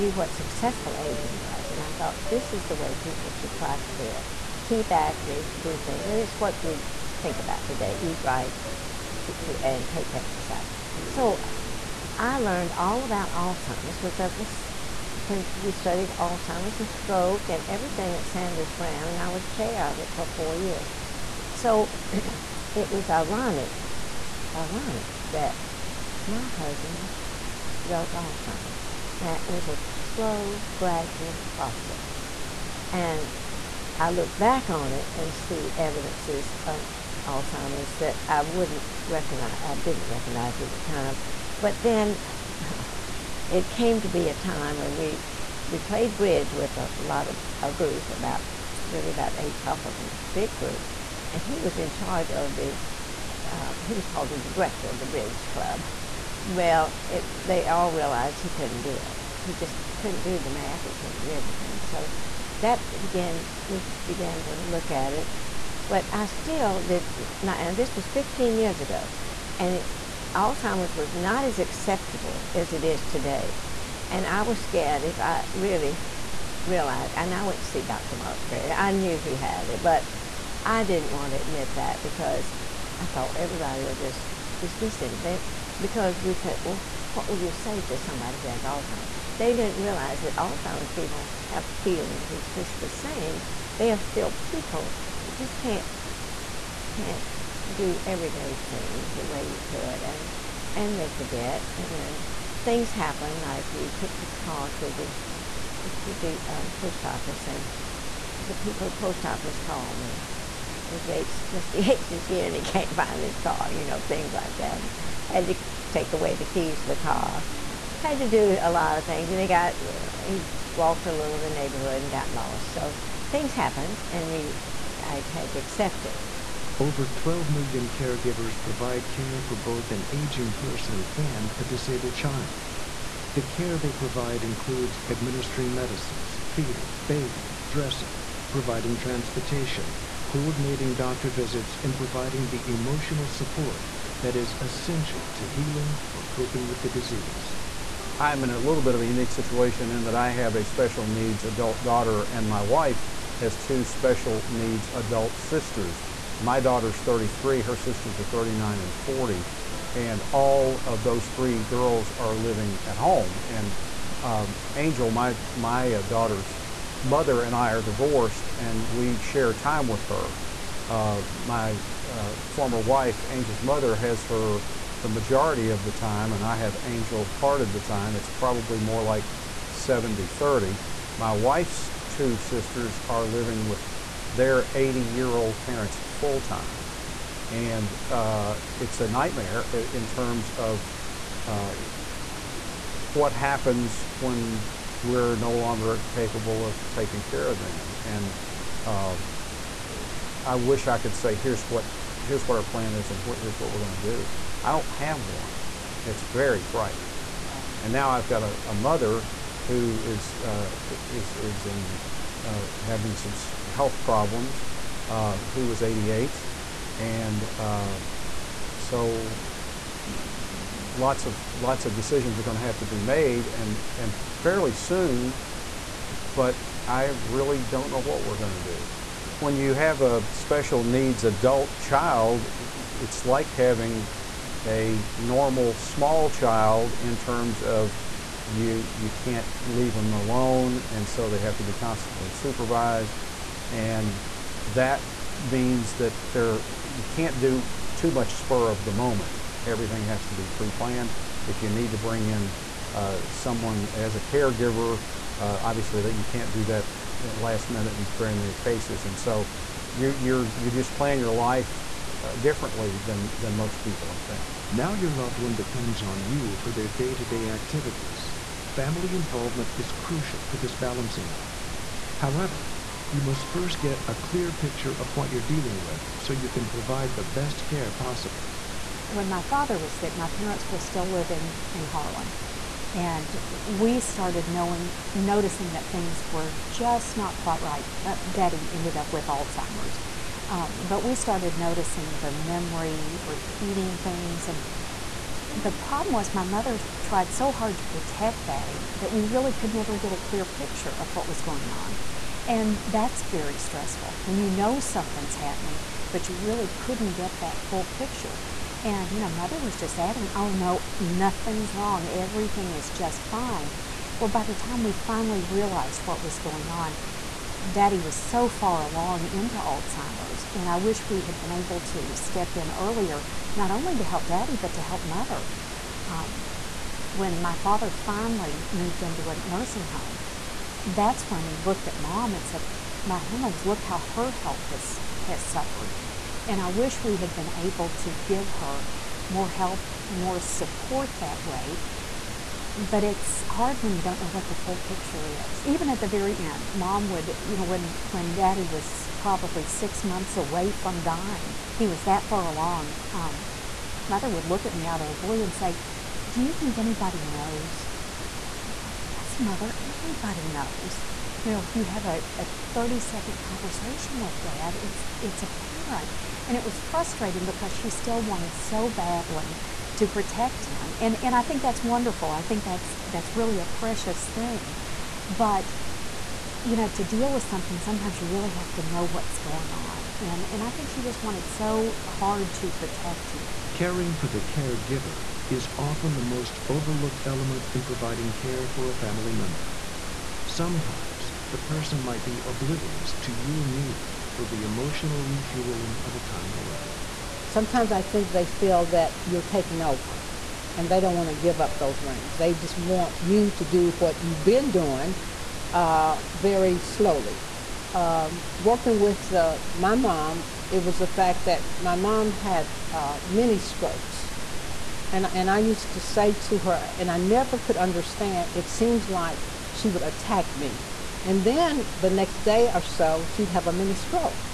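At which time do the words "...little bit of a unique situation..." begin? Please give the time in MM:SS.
02:28.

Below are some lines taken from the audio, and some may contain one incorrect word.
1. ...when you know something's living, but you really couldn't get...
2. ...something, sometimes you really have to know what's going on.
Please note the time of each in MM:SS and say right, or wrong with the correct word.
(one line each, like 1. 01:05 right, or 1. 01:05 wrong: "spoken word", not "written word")
1. 05:04 wrong: "happening", not "living"
2. 06:17 right.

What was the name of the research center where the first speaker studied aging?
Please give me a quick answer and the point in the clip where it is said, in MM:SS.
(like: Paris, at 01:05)
Sanders Brown, at 00:18.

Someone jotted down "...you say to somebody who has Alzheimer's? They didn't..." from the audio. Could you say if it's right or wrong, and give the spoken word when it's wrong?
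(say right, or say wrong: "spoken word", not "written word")
right.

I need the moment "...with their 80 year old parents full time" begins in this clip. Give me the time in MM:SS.
03:03.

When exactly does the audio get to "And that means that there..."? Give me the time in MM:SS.
04:03.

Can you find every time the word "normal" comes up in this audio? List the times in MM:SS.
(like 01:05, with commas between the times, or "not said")
03:55.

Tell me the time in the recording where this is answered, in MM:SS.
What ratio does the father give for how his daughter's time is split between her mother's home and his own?
02:59.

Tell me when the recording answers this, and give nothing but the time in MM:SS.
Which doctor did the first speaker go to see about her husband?
01:17.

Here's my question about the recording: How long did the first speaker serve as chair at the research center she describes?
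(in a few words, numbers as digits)
4 years.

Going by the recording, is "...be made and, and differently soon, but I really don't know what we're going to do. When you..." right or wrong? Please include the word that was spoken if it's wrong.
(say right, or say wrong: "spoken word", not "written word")
wrong: "fairly", not "differently".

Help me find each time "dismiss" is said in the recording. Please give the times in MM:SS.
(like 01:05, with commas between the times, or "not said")
01:24.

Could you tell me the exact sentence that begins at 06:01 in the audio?
You know, if you have a, a 30 second conversation with dad.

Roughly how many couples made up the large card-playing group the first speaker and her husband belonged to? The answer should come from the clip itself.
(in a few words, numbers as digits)
8.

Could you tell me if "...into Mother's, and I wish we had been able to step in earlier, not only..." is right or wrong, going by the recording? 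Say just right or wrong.
wrong.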